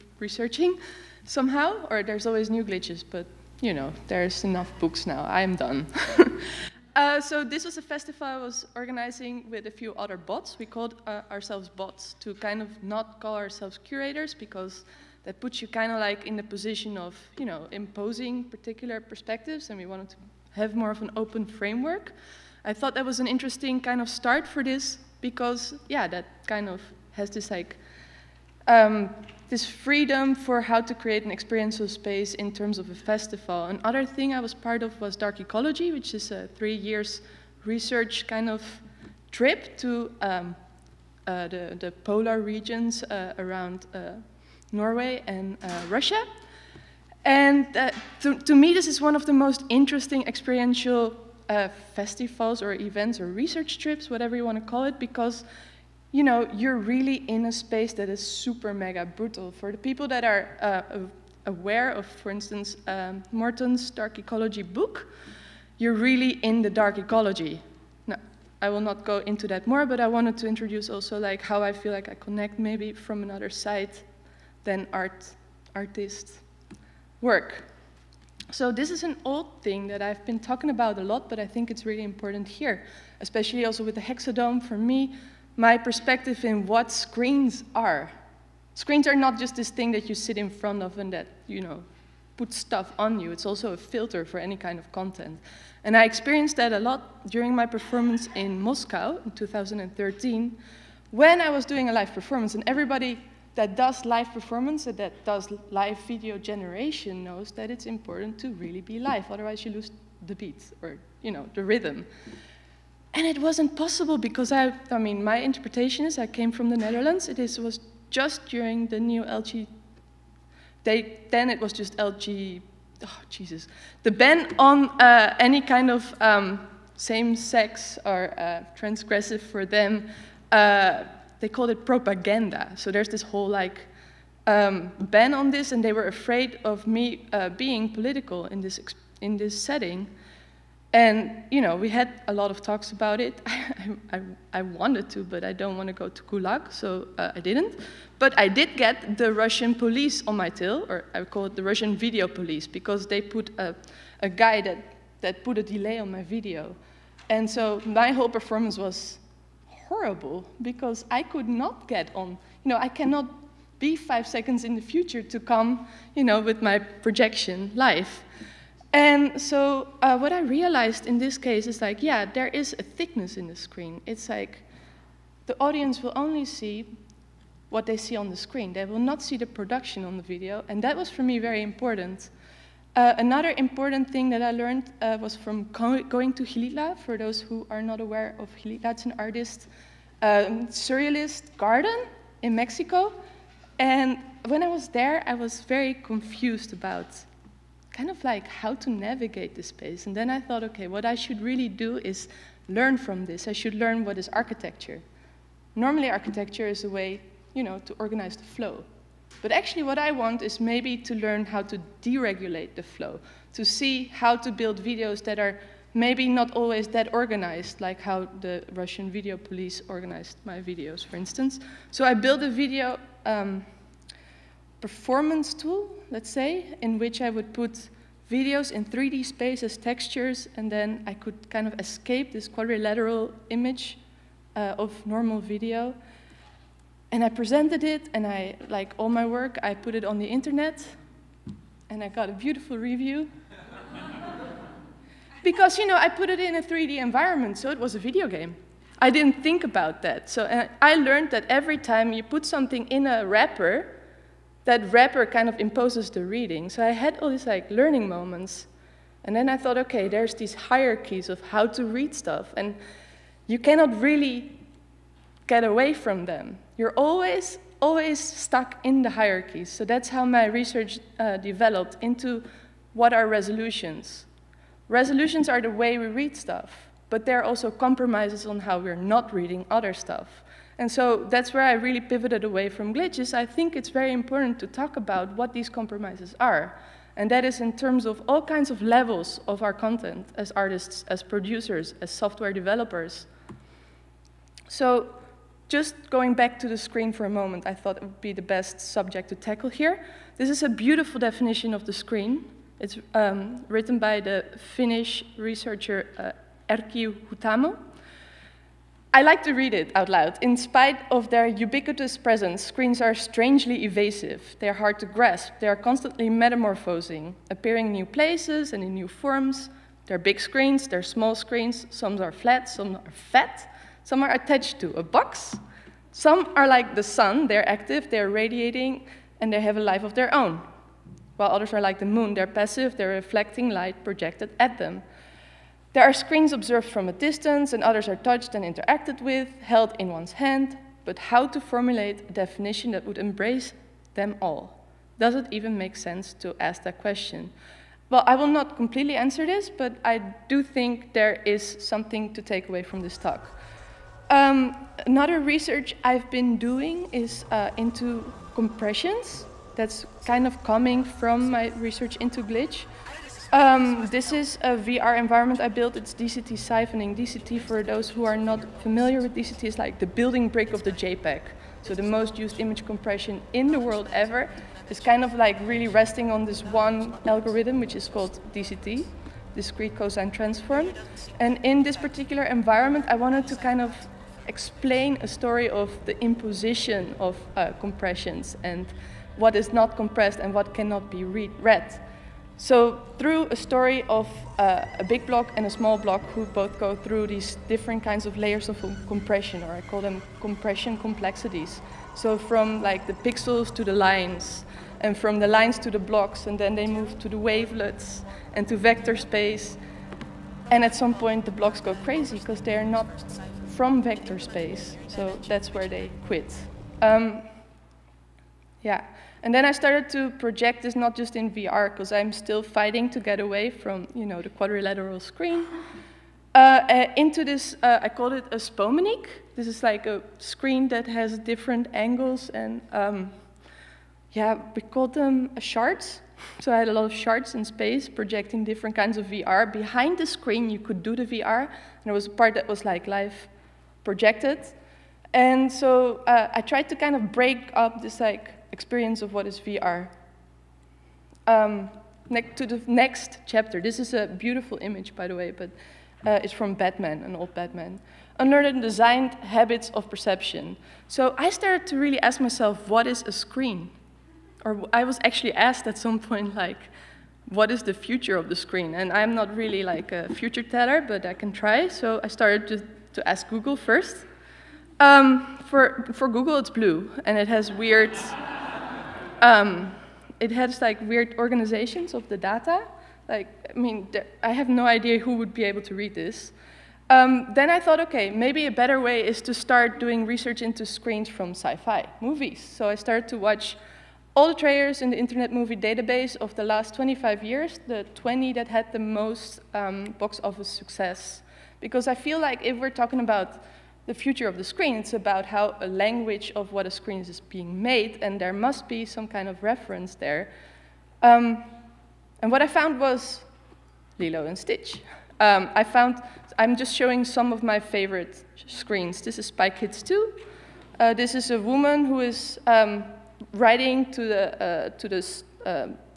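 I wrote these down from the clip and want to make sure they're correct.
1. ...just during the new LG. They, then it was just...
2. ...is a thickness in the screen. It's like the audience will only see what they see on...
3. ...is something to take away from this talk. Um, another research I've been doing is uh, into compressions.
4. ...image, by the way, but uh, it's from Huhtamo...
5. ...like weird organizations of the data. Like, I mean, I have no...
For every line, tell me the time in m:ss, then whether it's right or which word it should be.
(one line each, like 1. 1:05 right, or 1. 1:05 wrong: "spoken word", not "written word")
1. 1:58 right
2. 2:52 right
3. 5:51 right
4. 7:34 wrong: "Batman", not "Huhtamo"
5. 8:00 right.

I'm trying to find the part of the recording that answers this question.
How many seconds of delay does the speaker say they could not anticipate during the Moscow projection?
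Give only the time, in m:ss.
2:43.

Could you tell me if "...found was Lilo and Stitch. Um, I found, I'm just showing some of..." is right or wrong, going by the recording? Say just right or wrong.
right.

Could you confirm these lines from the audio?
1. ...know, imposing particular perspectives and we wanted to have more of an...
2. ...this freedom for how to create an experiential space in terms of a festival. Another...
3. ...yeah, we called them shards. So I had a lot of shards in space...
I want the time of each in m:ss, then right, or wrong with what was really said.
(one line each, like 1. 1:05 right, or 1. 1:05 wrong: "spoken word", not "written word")
1. 0:17 right
2. 0:29 right
3. 7:14 right.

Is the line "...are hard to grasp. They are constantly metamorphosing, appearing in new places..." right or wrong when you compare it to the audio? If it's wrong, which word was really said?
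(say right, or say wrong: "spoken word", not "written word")
right.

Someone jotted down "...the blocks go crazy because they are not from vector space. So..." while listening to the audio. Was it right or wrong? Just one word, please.
right.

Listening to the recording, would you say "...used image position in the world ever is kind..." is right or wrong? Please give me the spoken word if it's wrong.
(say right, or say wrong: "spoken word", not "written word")
wrong: "compression", not "position".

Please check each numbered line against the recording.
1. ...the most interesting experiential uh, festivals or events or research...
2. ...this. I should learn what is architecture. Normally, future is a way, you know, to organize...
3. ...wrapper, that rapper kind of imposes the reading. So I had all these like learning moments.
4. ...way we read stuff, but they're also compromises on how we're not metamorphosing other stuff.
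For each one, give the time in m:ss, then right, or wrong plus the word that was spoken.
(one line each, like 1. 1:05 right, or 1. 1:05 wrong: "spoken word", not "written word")
1. 0:49 right
2. 3:23 wrong: "architecture", not "future"
3. 4:13 right
4. 4:35 wrong: "reading", not "metamorphosing".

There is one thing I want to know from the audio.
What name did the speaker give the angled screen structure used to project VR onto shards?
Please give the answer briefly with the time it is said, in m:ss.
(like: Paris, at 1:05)
spomenik, at 7:08.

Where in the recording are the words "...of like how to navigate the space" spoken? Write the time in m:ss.
3:18.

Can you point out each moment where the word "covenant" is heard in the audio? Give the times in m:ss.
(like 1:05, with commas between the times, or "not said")
not said.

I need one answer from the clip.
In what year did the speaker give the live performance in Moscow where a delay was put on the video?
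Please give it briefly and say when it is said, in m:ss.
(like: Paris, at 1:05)
2013, at 1:39.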